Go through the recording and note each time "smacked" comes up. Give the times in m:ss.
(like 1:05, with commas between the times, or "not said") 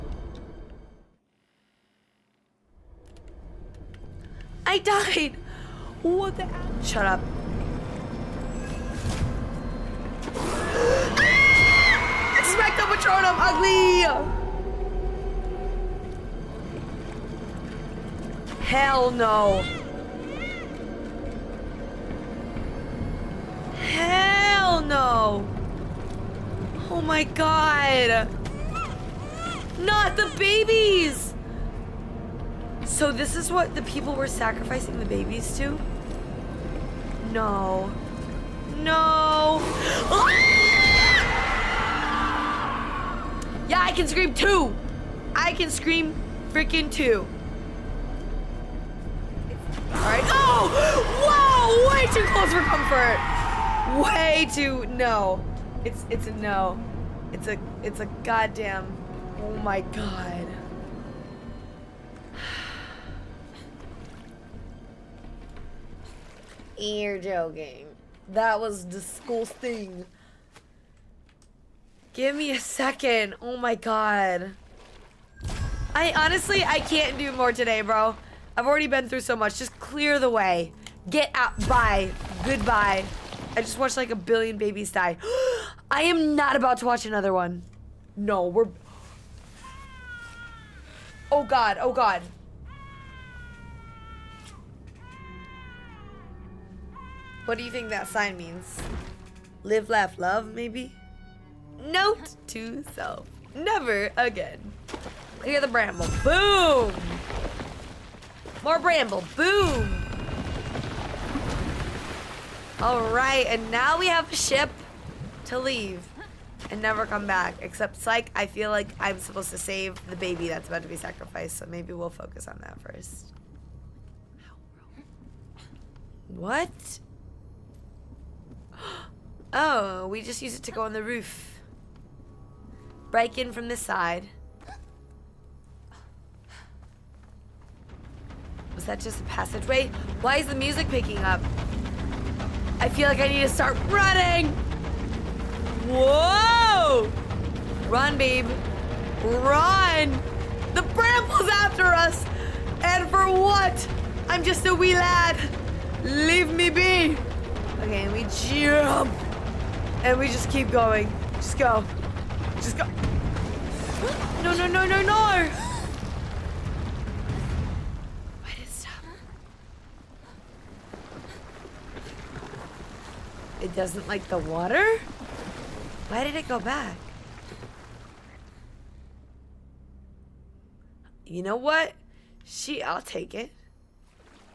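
0:12.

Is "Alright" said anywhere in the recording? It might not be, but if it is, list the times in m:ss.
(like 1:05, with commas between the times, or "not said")
1:52.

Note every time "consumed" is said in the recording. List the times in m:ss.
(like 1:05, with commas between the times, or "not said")
not said.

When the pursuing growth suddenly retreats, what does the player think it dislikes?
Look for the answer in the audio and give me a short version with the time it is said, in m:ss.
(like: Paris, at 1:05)
the water, at 2:54.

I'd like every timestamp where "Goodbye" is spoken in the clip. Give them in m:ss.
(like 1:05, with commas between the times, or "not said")
1:22.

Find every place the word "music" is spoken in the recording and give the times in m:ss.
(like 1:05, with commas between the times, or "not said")
2:20.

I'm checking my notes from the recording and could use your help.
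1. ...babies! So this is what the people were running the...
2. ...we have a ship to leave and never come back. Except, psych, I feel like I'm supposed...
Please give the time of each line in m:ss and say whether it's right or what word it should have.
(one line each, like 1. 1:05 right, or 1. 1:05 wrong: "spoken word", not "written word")
1. 0:30 wrong: "sacrificing", not "running"
2. 1:53 right.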